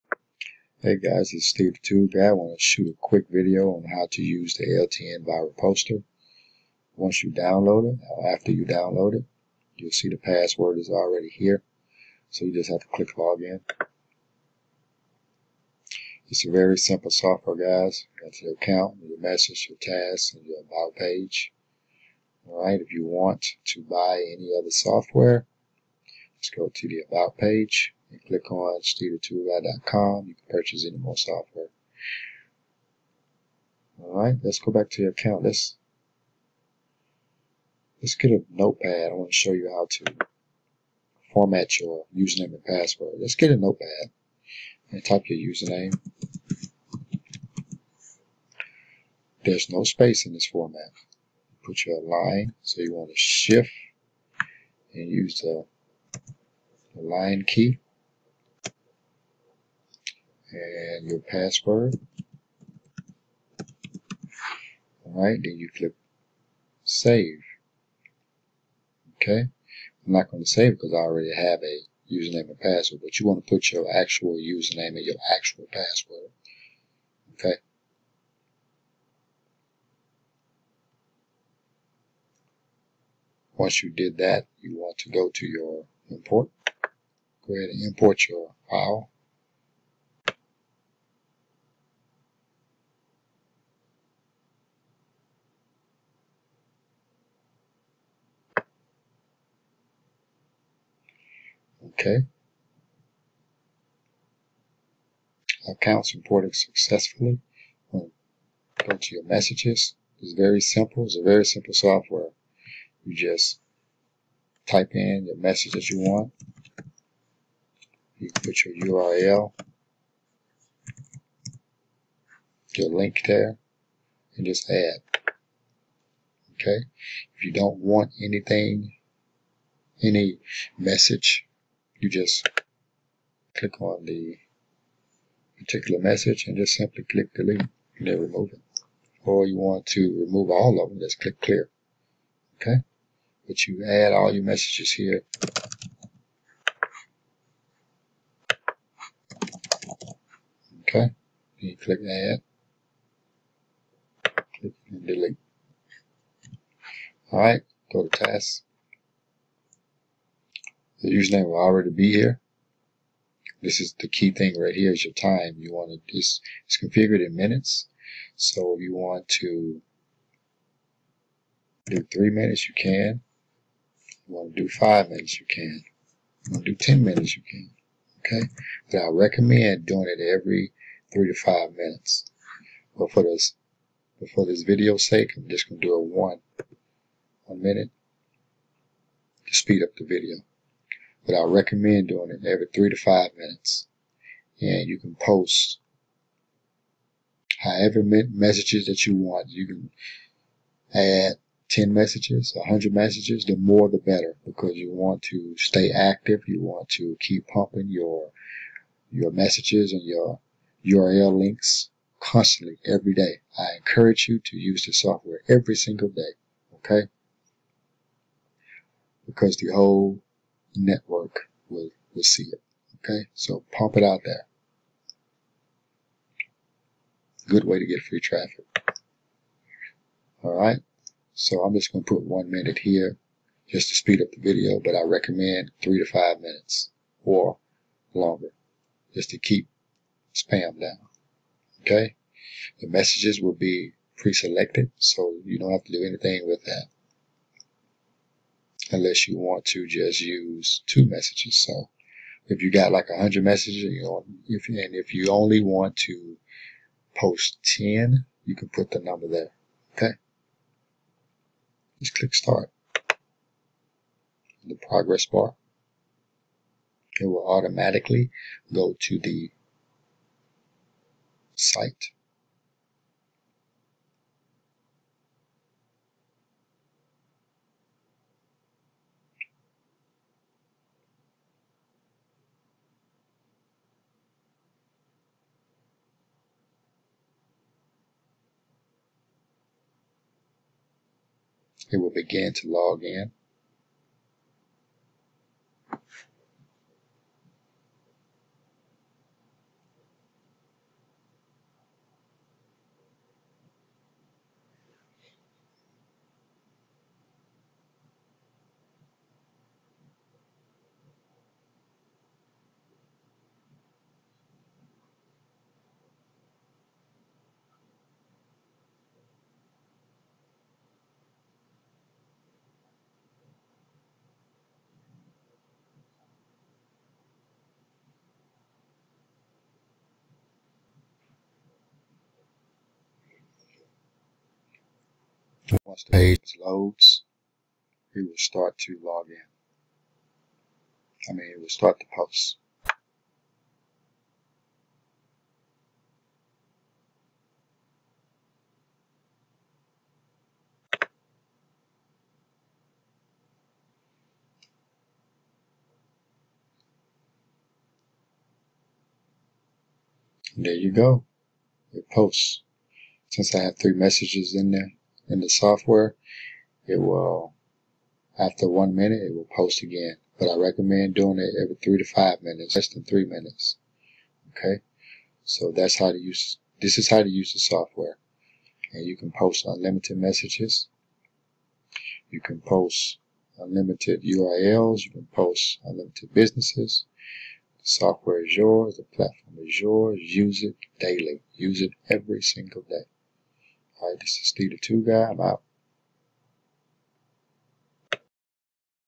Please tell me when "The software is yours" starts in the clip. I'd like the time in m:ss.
6:27.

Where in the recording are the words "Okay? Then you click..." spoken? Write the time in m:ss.
2:30.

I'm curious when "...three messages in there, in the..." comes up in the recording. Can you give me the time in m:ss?
6:03.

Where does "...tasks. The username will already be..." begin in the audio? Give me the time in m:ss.
2:38.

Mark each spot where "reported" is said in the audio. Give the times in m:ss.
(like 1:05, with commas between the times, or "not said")
1:46.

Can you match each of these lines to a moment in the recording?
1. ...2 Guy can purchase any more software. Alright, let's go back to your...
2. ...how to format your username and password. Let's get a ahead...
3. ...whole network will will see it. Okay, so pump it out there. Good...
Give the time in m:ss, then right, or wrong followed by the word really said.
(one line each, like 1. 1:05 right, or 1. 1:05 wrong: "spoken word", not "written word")
1. 0:29 wrong: "You", not "Guy"
2. 0:39 wrong: "notepad", not "ahead"
3. 3:39 right.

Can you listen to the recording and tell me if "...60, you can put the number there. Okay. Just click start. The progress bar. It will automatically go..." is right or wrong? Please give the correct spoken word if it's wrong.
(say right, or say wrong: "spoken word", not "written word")
wrong: "10", not "60".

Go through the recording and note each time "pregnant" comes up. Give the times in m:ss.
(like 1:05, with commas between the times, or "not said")
not said.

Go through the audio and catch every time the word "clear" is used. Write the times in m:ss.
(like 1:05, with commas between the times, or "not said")
2:21.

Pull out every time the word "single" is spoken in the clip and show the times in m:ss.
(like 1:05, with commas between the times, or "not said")
3:35, 6:32.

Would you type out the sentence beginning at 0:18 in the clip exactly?
Got your account, your message, your tasks, and your about page.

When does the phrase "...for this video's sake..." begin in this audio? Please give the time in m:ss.
3:04.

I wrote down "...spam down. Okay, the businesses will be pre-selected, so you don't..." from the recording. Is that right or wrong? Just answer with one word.
wrong.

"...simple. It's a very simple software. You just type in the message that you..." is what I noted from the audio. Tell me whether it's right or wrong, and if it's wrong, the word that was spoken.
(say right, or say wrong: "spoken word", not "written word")
right.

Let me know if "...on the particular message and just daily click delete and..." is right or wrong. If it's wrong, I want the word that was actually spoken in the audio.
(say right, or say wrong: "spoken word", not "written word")
wrong: "simply", not "daily".